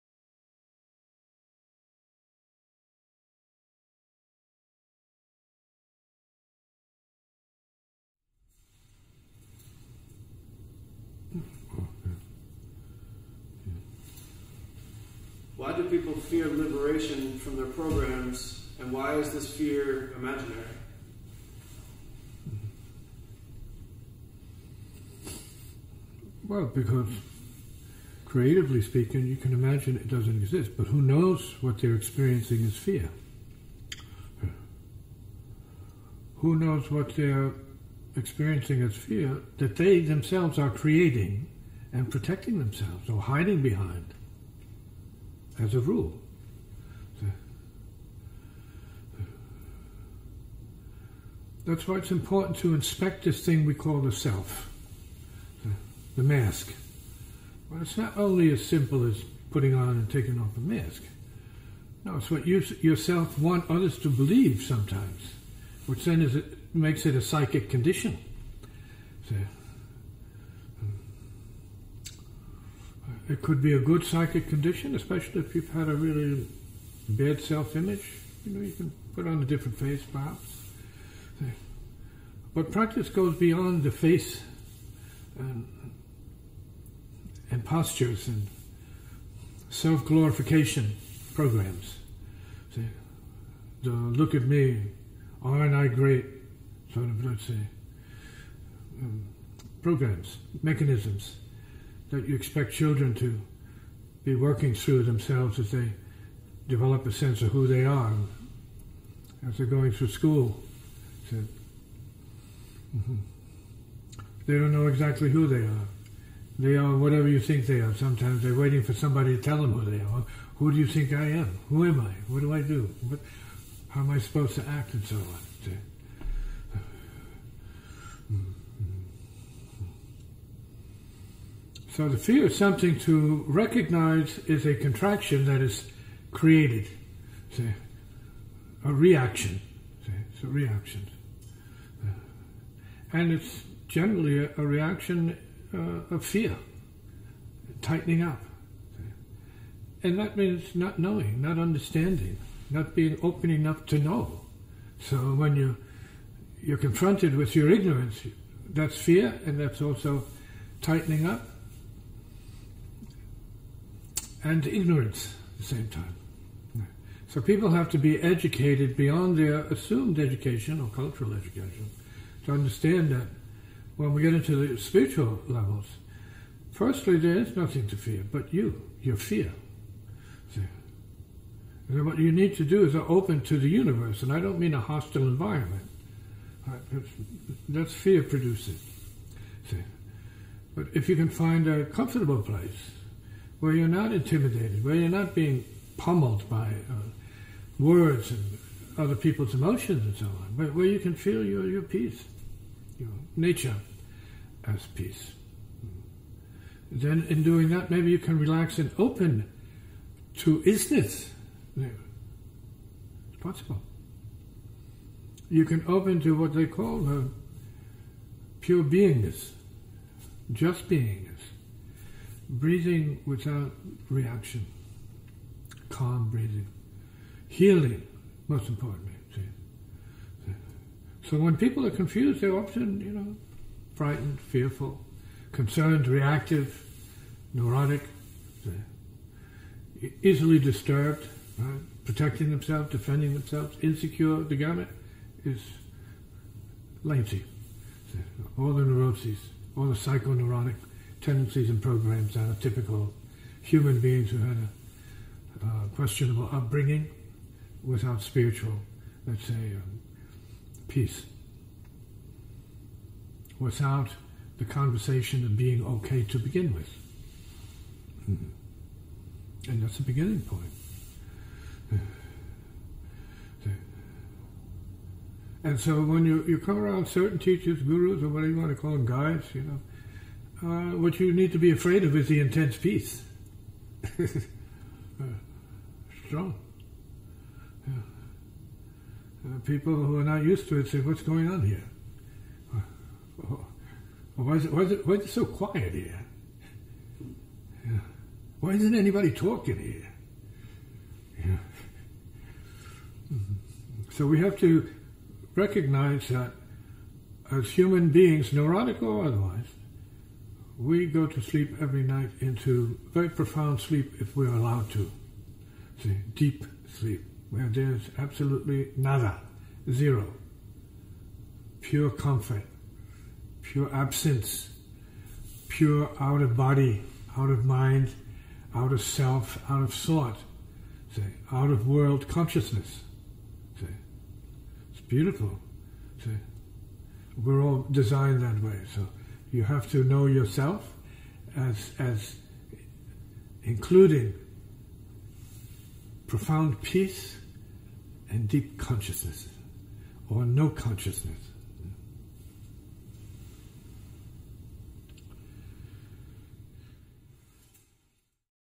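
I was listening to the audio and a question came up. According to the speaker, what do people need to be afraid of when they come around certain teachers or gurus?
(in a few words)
intense peace.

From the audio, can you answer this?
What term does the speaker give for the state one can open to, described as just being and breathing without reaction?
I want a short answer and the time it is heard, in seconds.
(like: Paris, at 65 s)
pure beingness, at 218 s.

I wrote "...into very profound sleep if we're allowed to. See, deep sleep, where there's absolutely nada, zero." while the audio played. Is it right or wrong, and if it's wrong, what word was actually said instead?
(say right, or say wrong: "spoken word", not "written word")
right.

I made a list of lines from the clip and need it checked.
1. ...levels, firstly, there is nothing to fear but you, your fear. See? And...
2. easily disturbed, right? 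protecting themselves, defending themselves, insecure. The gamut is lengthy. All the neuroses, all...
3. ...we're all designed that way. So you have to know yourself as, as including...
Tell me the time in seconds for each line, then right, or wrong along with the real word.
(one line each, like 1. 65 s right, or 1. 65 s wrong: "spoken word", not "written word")
1. 175 s right
2. 240 s right
3. 337 s right.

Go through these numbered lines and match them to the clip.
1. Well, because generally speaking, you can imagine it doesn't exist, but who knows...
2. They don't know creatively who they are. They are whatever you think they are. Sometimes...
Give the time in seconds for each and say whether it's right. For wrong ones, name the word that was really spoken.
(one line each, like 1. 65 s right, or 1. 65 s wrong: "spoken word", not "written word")
1. 26 s wrong: "creatively", not "generally"
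2. 114 s wrong: "exactly", not "creatively".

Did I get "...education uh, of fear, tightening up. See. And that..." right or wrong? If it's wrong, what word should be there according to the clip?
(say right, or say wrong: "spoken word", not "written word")
wrong: "reaction", not "education".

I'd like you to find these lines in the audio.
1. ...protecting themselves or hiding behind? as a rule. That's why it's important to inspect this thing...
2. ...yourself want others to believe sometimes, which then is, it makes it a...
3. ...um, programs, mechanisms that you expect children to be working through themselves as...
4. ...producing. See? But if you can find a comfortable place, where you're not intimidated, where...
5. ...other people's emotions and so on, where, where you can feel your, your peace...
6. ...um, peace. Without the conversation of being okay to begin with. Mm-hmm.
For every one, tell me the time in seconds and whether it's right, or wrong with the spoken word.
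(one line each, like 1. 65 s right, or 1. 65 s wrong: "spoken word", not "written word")
1. 42 s right
2. 62 s right
3. 99 s right
4. 188 s right
5. 198 s right
6. 259 s right.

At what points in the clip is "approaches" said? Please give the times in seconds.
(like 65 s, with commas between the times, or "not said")
not said.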